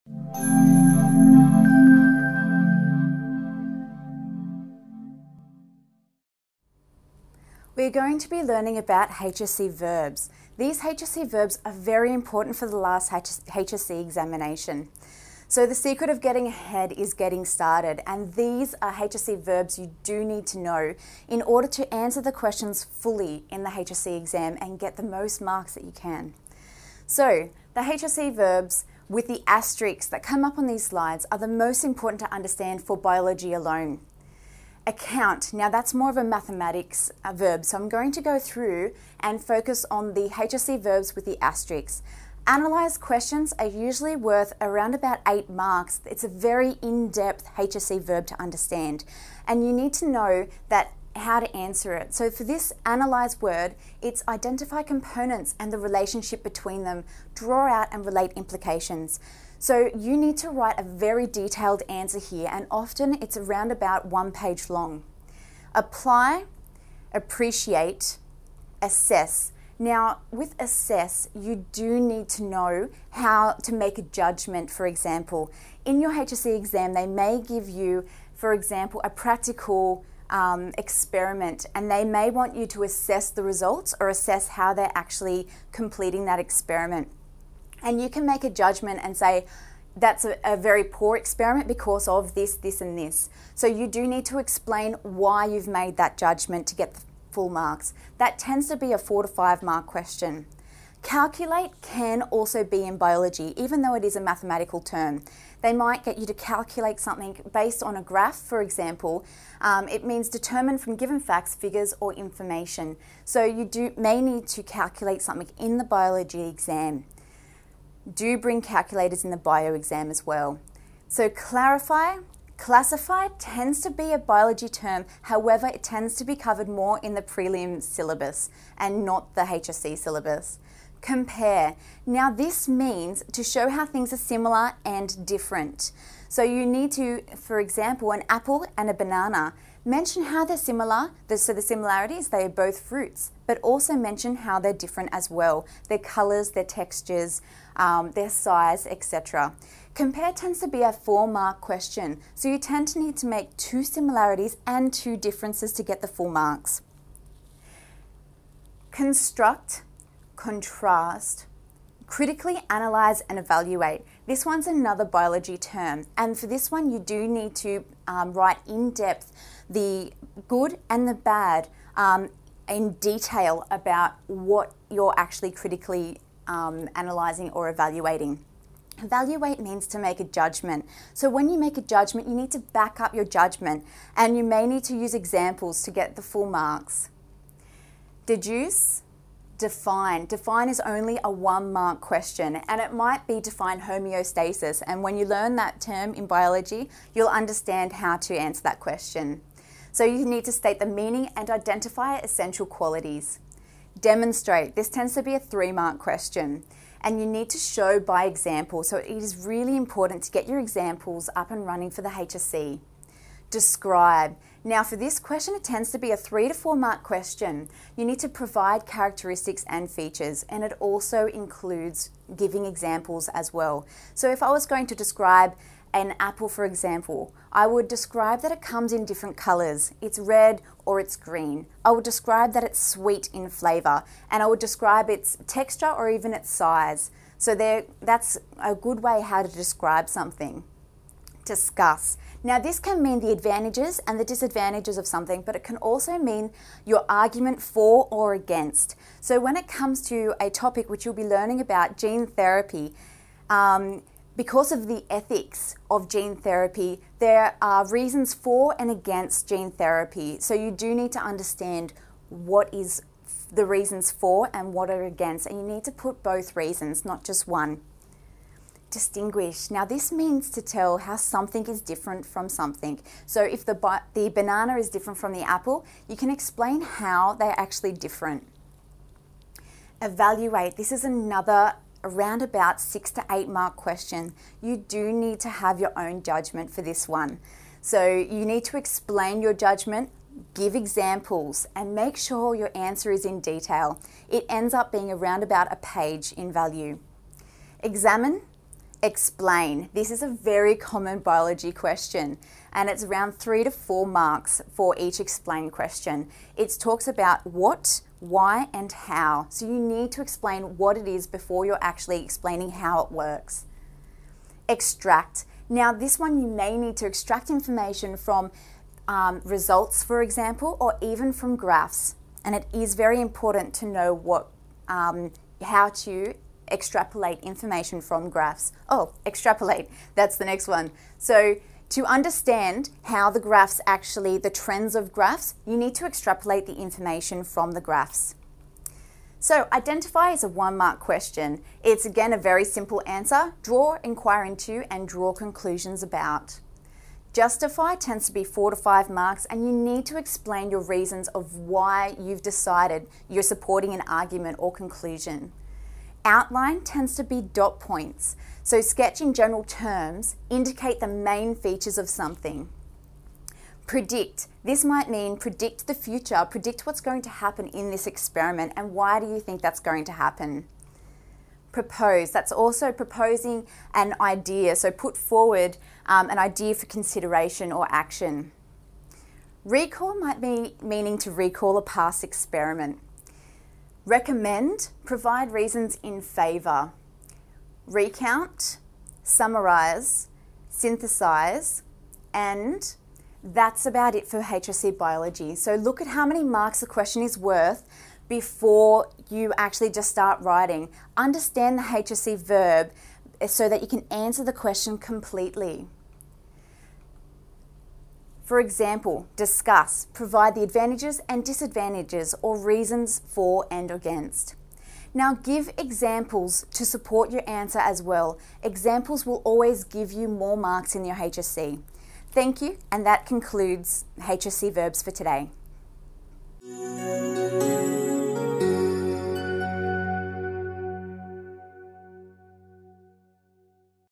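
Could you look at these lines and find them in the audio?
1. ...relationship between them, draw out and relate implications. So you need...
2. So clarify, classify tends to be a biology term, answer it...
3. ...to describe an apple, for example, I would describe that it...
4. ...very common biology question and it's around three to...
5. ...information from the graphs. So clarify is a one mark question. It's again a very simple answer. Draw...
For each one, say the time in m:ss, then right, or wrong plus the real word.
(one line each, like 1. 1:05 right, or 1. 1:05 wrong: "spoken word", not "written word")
1. 0:55 right
2. 2:01 wrong: "however", not "answer"
3. 3:44 right
4. 5:00 right
5. 5:36 wrong: "identify", not "clarify".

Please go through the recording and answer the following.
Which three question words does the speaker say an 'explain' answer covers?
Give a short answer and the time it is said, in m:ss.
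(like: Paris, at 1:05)
what, why and how, at 5:07.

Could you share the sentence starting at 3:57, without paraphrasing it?
So there, that's a good way how to describe something discuss.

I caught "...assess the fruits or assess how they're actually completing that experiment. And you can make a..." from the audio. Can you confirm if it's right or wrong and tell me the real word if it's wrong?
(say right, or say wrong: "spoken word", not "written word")
wrong: "results", not "fruits".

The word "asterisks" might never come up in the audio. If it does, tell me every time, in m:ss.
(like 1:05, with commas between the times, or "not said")
0:29, 0:41.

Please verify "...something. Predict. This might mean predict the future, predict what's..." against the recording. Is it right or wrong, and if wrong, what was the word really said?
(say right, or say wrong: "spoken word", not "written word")
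right.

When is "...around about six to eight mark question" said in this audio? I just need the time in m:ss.
4:42.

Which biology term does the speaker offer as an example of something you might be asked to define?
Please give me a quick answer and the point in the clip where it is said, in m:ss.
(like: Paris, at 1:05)
homeostasis, at 3:13.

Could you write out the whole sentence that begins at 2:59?
Evaluate means to make a judgment.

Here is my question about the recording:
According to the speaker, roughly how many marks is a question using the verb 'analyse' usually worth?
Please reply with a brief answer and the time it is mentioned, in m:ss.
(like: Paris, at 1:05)
8, at 0:45.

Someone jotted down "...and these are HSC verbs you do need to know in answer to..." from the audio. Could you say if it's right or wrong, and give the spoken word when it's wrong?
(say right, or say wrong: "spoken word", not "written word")
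wrong: "order", not "answer".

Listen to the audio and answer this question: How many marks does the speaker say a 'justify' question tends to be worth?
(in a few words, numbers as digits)
4 to 5.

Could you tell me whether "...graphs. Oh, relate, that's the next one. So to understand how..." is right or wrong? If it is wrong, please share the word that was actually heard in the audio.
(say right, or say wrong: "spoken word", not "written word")
wrong: "extrapolate", not "relate".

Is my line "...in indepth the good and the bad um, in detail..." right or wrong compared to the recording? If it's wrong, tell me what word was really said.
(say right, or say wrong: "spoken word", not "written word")
wrong: "depth", not "indepth".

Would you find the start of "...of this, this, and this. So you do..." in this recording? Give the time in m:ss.
1:32.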